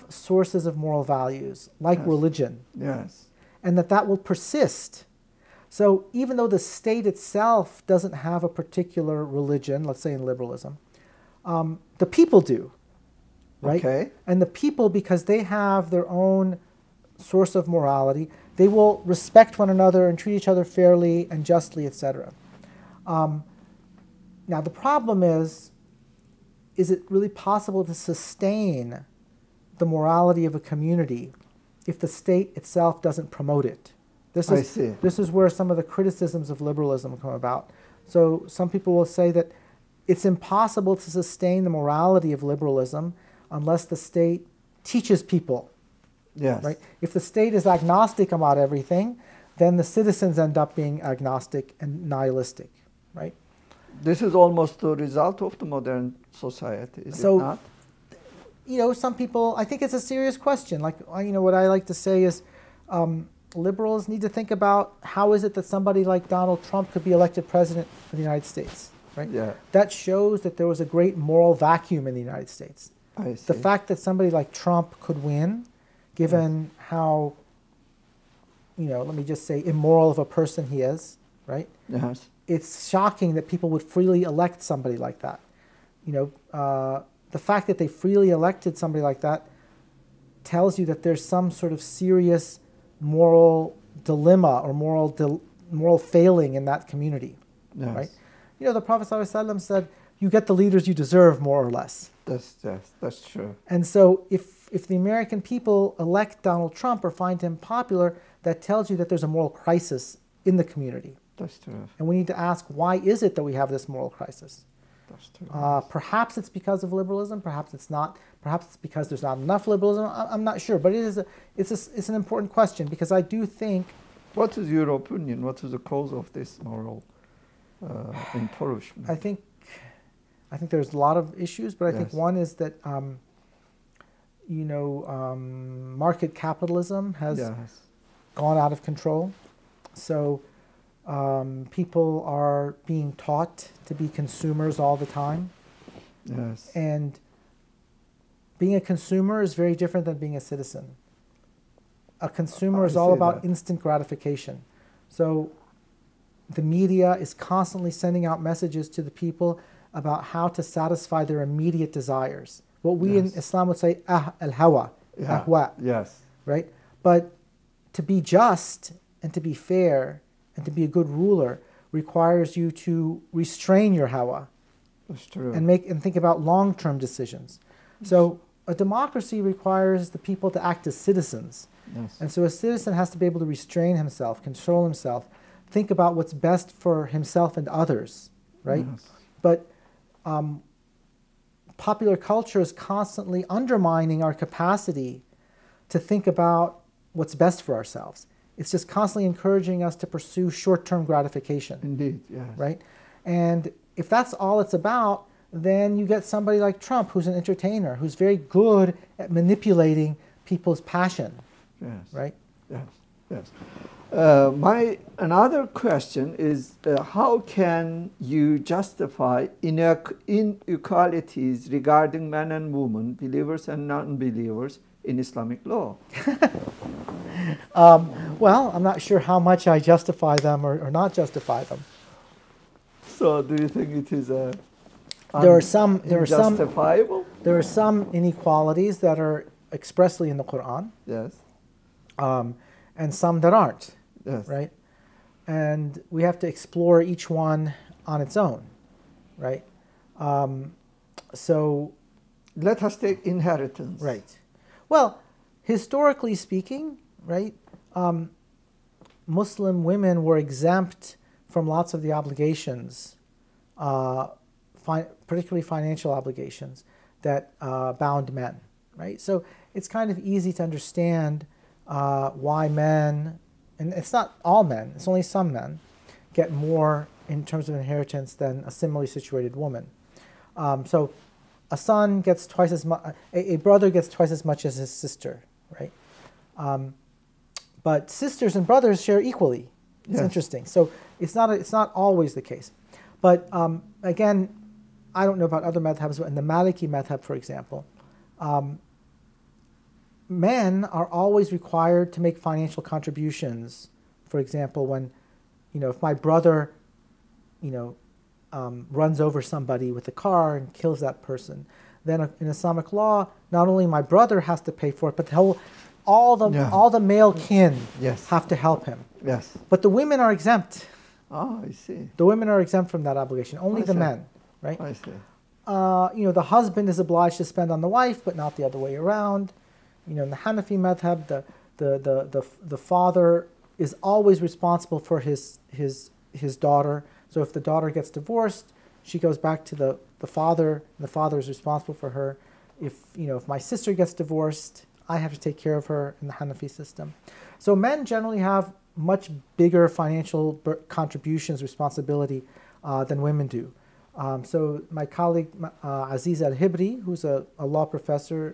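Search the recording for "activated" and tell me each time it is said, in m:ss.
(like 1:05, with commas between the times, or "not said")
not said.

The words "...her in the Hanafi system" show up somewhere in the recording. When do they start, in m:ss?
5:45.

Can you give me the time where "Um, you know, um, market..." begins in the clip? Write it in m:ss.
2:12.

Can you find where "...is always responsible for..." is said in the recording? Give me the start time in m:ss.
5:33.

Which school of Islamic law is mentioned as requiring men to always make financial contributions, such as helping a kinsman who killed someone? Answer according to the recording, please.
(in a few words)
Maliki.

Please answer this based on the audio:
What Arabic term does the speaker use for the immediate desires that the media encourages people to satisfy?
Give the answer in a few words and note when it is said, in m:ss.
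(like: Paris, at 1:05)
al hawa, at 2:44.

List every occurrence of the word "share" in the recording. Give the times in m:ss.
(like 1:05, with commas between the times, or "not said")
4:49.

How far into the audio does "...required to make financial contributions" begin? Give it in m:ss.
5:01.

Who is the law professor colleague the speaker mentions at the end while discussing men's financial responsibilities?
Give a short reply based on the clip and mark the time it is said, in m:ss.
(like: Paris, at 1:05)
Azizah Al Hibri, at 5:56.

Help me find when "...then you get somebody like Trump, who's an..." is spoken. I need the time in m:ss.
3:25.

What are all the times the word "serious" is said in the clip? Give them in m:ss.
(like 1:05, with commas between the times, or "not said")
0:59, 1:31.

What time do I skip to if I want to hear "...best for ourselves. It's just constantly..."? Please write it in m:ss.
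3:17.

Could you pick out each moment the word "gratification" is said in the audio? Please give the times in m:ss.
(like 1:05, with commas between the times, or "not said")
2:33, 3:21.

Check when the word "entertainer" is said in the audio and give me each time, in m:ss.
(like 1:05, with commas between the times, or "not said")
3:27.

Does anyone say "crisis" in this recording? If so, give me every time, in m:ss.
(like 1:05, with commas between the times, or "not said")
1:49, 1:54.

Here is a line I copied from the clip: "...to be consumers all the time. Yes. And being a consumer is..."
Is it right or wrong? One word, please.
right.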